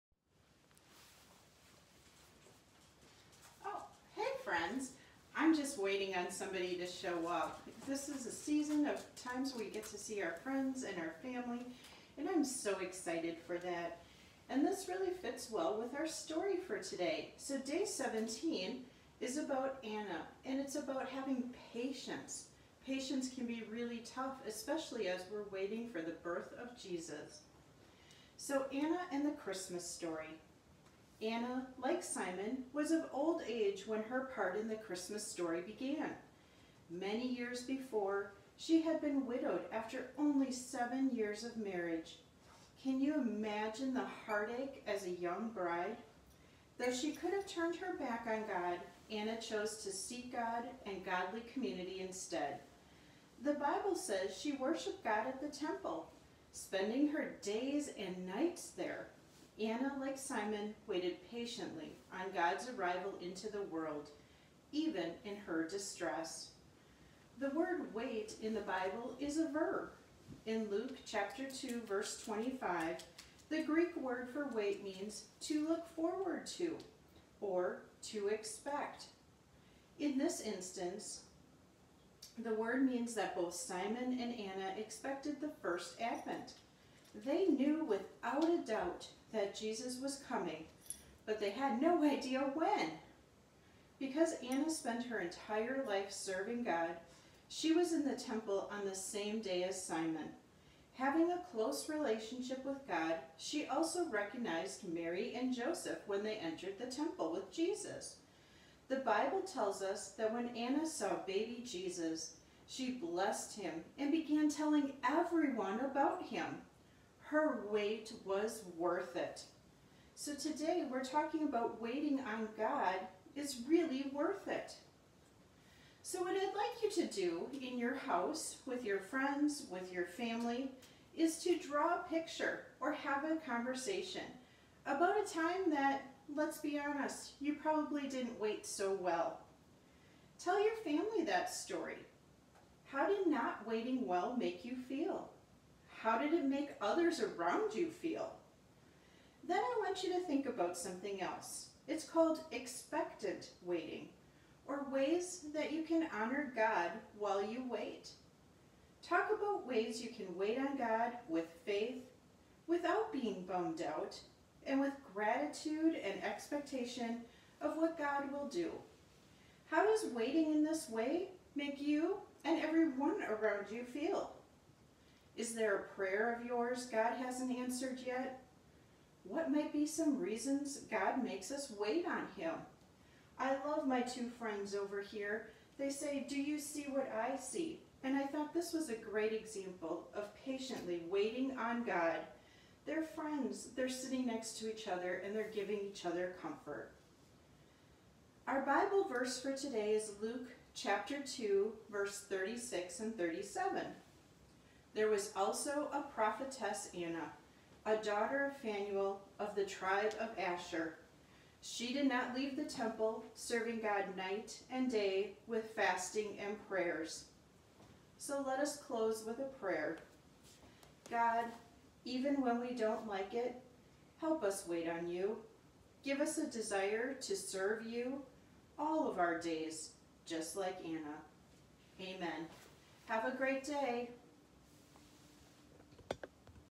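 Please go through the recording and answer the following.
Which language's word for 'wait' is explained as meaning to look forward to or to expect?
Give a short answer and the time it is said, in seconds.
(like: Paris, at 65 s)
Greek, at 73 s.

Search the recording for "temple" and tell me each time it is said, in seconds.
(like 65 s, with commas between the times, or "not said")
55 s, 98 s, 106 s, 212 s.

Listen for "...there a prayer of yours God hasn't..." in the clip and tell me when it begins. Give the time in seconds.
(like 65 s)
175 s.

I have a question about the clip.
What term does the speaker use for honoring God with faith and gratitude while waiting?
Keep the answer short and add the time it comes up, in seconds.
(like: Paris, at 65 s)
expectant waiting, at 152 s.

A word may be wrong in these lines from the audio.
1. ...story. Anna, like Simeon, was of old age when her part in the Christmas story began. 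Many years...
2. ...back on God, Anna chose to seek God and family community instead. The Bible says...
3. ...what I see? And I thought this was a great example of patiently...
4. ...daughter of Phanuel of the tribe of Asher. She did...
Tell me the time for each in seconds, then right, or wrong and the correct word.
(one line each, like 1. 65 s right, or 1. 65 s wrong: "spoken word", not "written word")
1. 29 s right
2. 47 s wrong: "godly", not "family"
3. 186 s right
4. 207 s right.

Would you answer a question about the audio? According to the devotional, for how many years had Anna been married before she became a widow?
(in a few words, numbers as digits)
7.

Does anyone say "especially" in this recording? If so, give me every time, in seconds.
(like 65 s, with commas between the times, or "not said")
24 s.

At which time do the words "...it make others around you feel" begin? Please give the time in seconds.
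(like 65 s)
146 s.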